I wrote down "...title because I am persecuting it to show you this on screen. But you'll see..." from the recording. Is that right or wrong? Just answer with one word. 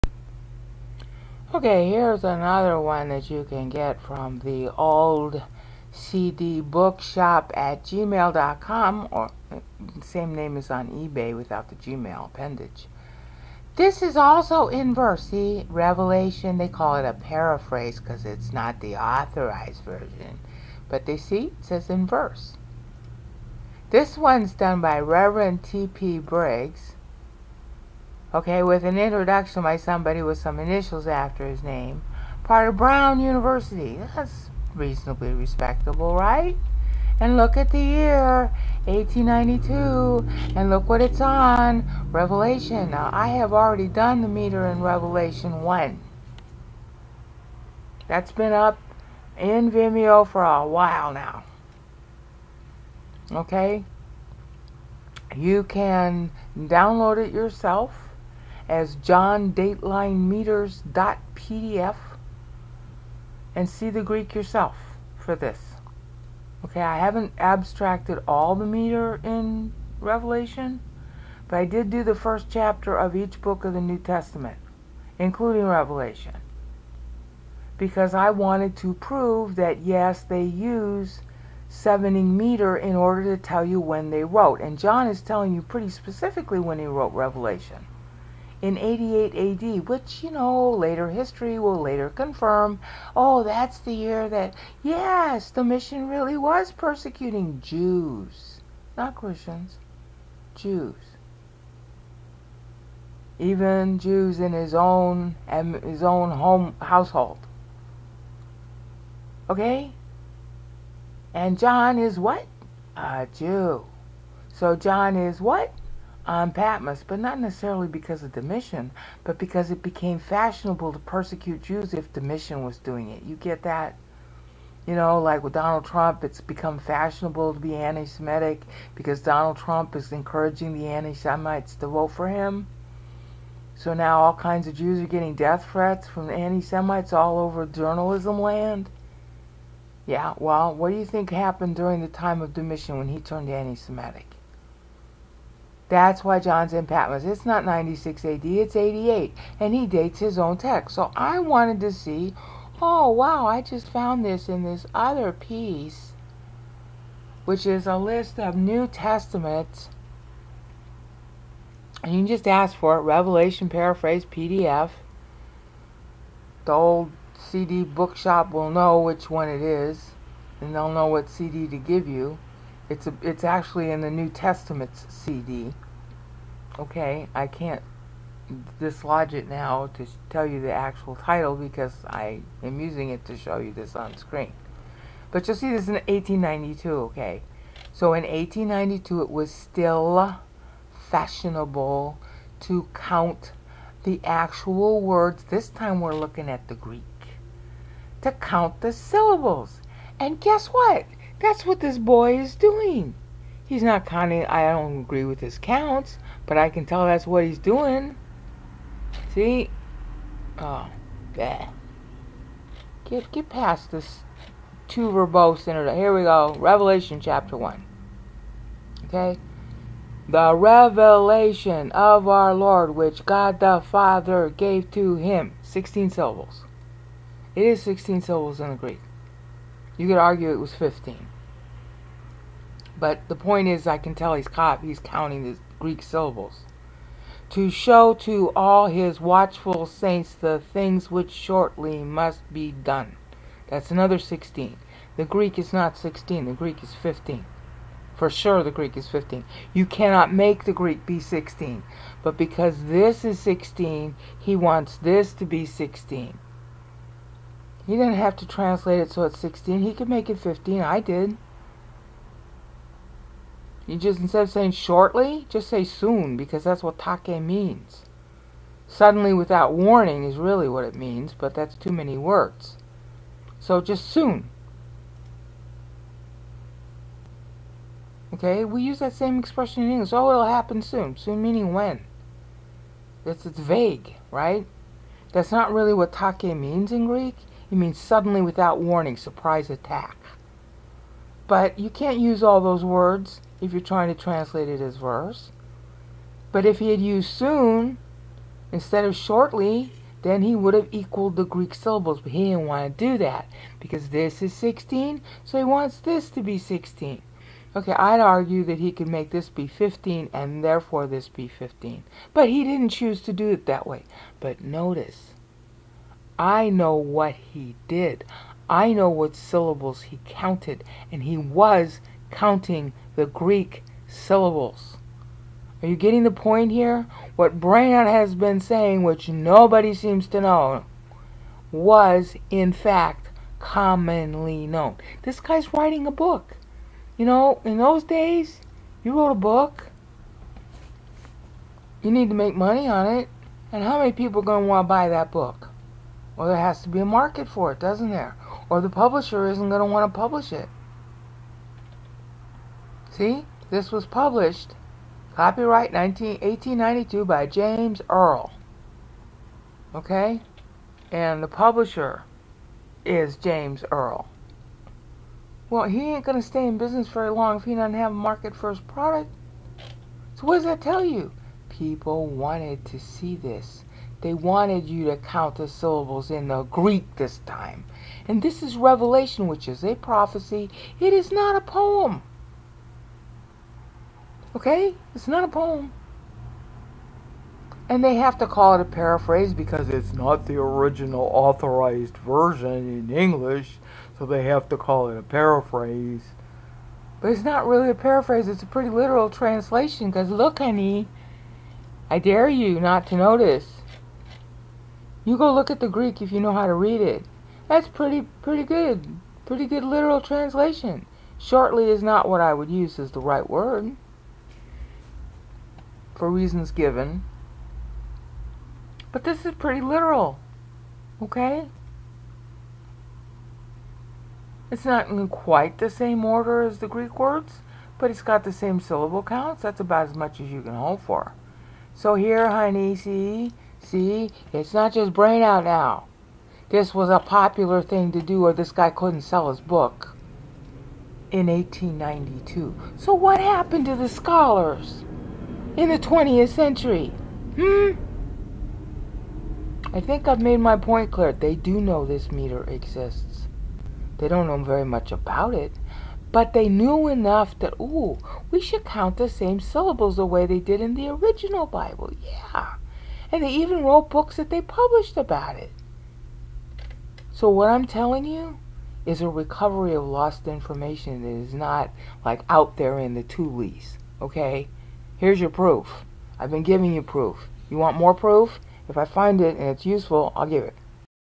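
wrong.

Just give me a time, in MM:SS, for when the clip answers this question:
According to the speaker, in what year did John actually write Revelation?
01:28.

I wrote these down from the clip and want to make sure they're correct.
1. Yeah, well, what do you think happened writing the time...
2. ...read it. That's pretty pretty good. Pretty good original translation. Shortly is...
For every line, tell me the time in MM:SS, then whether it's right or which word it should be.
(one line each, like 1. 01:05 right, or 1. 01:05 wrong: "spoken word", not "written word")
1. 02:20 wrong: "during", not "writing"
2. 06:46 wrong: "literal", not "original".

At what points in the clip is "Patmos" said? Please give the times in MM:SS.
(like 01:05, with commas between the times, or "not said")
01:56, 02:26.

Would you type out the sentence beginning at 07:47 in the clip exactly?
So, what I'm telling you is a recovery of lost information that is not like out there in the toolies.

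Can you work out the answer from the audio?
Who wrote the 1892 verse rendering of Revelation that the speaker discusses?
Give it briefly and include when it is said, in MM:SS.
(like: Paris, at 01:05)
Reverend T.P. Briggs, at 00:25.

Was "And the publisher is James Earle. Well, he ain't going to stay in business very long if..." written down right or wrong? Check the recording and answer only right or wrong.
right.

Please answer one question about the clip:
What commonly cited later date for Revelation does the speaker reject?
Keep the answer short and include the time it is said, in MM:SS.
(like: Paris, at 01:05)
96 AD, at 02:27.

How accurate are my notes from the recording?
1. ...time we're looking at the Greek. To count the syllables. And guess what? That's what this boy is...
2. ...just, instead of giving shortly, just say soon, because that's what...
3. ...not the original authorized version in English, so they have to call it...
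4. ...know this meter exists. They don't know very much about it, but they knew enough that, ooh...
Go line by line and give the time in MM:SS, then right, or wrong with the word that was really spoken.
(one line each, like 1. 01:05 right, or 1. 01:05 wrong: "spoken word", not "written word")
1. 03:15 right
2. 04:23 wrong: "saying", not "giving"
3. 06:30 right
4. 07:31 right.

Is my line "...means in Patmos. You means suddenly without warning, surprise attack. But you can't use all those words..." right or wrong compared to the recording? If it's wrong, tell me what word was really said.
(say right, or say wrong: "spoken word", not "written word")
wrong: "Greek", not "Patmos".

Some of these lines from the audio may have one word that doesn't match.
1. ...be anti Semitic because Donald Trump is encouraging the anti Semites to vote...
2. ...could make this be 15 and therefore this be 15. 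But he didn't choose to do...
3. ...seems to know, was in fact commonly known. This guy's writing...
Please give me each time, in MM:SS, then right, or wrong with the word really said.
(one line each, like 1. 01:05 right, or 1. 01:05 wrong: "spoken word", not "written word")
1. 02:07 right
2. 05:08 right
3. 05:29 right.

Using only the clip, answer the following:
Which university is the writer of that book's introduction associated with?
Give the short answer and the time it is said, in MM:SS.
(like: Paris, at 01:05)
Brown University, at 00:32.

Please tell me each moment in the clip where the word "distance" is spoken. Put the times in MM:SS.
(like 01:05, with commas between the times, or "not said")
not said.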